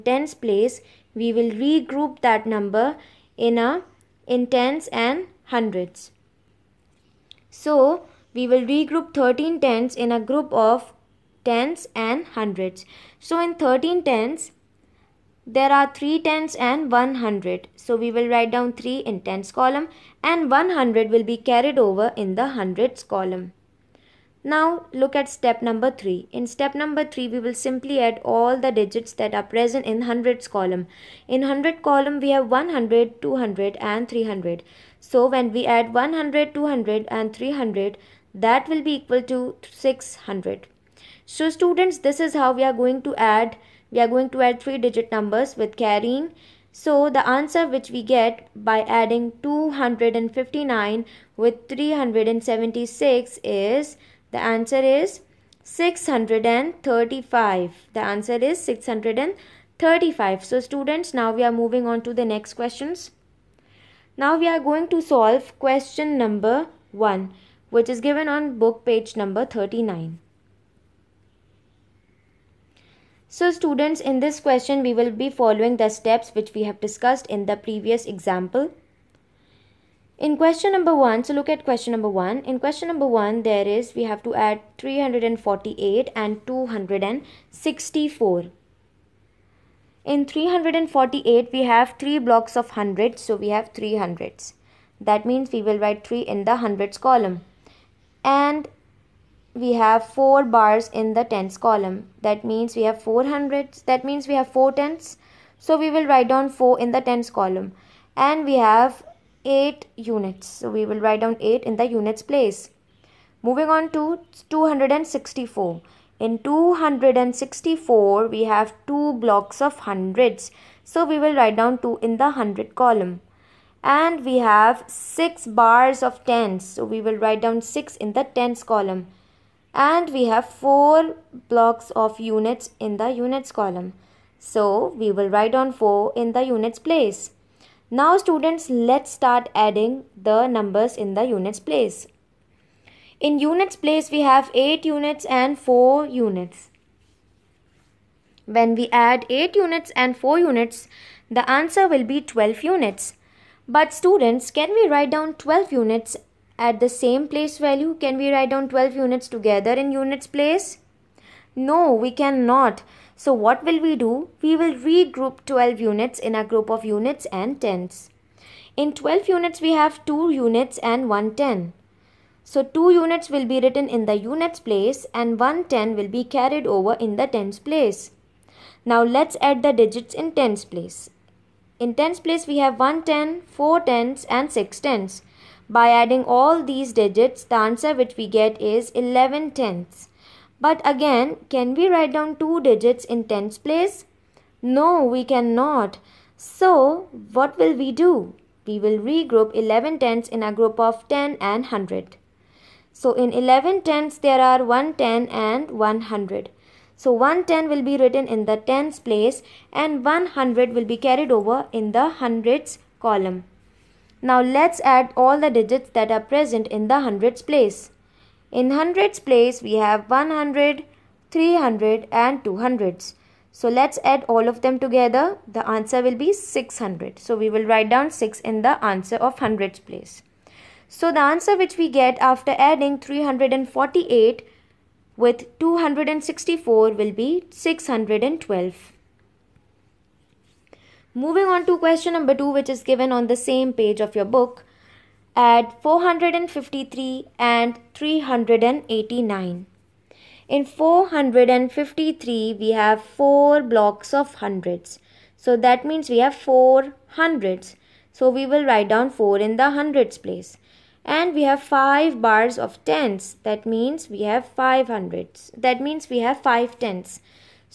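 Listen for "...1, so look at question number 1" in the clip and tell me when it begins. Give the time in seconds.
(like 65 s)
80 s.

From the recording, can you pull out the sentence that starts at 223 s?
So let's add all of them together.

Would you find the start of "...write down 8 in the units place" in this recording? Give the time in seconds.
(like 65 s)
111 s.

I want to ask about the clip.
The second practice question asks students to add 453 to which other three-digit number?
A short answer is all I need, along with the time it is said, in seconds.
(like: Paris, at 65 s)
389, at 247 s.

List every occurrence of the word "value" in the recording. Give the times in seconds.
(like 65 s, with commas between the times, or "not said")
157 s.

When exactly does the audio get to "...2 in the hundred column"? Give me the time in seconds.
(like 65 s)
121 s.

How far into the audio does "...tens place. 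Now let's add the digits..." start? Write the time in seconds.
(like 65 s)
177 s.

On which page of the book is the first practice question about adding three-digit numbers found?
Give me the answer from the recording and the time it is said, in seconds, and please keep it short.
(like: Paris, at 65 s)
39, at 68 s.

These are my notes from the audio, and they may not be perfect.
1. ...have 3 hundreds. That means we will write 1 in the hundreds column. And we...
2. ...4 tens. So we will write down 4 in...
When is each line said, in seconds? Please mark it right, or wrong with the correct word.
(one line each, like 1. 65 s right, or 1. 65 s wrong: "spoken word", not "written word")
1. 93 s wrong: "3", not "1"
2. 104 s right.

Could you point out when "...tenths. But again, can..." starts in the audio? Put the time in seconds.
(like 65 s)
189 s.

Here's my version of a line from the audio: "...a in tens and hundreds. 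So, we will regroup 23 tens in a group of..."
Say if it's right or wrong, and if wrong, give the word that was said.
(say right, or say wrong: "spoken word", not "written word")
wrong: "13", not "23".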